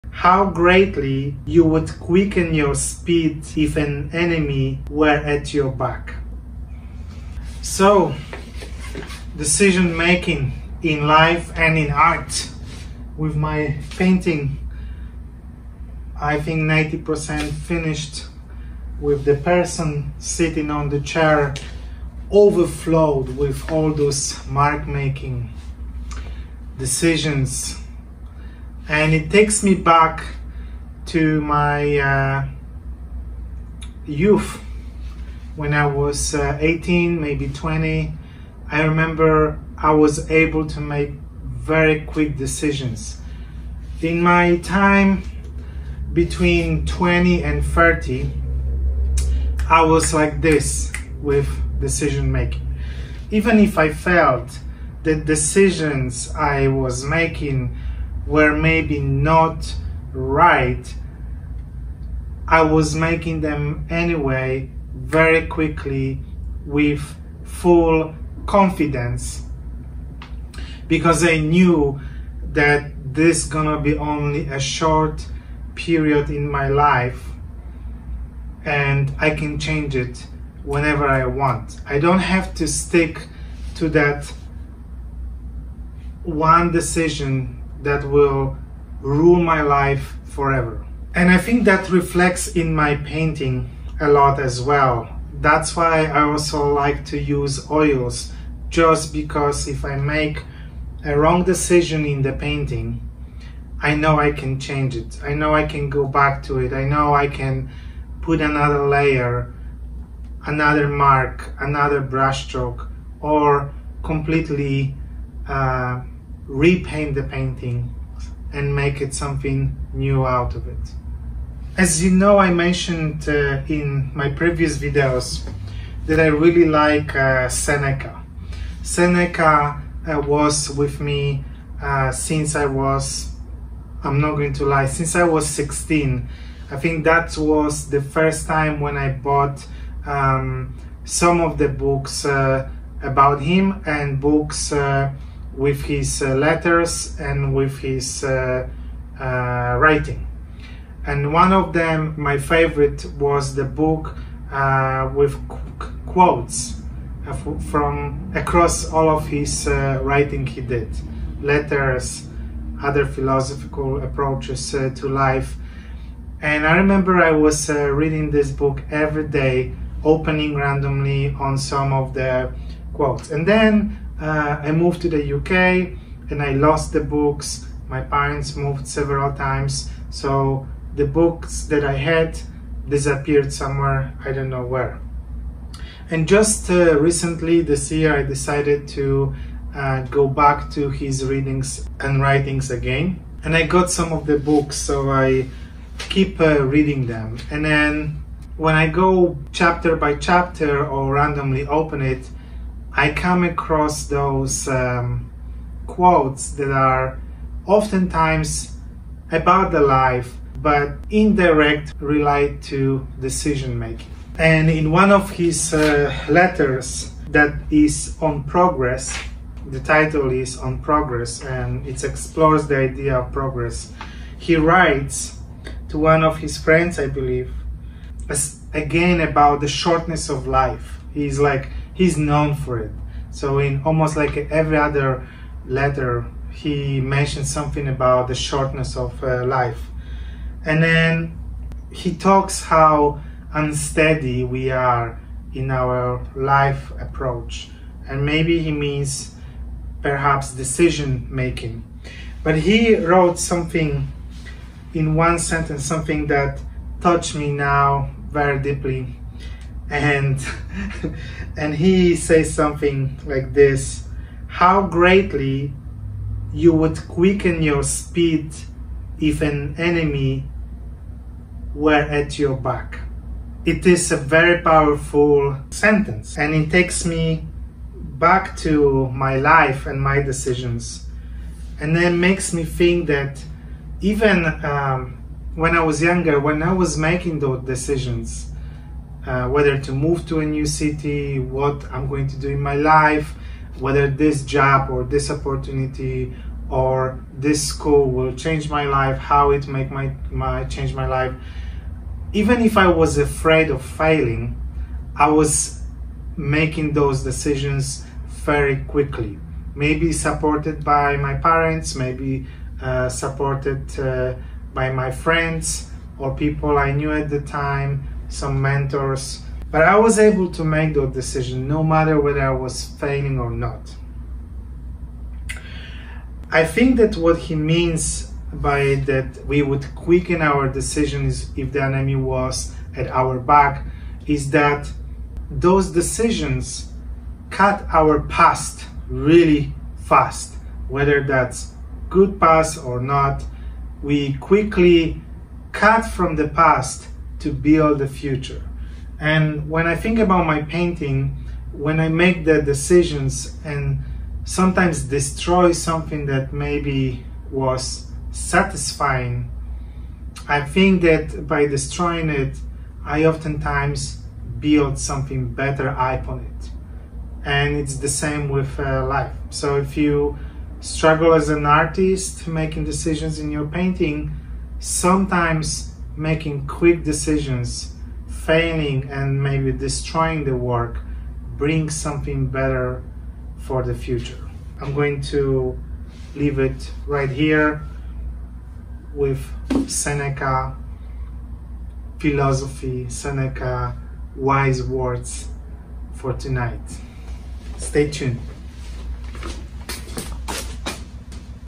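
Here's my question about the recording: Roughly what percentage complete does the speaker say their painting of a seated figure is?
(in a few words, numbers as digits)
90%.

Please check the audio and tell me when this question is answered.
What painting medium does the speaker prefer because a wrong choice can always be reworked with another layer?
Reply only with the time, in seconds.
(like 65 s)
97 s.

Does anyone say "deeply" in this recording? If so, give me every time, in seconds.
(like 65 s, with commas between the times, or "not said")
258 s.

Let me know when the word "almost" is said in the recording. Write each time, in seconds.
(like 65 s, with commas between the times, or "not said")
233 s.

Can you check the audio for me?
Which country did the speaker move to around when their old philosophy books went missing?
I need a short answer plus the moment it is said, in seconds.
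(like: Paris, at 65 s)
the UK, at 175 s.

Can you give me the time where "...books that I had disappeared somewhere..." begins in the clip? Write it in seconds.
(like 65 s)
181 s.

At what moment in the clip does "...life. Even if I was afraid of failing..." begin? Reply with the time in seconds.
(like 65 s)
301 s.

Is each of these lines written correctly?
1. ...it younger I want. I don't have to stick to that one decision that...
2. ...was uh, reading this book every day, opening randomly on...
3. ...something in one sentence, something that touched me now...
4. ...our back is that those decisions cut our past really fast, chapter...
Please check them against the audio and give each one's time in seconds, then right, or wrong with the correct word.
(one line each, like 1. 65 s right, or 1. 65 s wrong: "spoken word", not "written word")
1. 79 s wrong: "whenever", not "younger"
2. 167 s right
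3. 253 s right
4. 333 s wrong: "whether", not "chapter".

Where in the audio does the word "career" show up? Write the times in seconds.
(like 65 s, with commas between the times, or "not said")
not said.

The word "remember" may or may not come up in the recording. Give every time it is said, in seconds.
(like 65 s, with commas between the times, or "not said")
38 s, 166 s.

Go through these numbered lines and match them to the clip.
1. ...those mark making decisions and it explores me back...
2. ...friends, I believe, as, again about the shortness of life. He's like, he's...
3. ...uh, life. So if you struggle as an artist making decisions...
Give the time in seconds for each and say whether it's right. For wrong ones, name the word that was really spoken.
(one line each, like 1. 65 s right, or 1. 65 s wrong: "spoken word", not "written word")
1. 23 s wrong: "takes", not "explores"
2. 226 s right
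3. 368 s right.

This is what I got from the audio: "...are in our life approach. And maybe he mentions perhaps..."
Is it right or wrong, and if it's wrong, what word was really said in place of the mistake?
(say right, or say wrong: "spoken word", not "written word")
wrong: "means", not "mentions".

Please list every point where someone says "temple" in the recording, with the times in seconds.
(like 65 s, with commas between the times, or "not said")
not said.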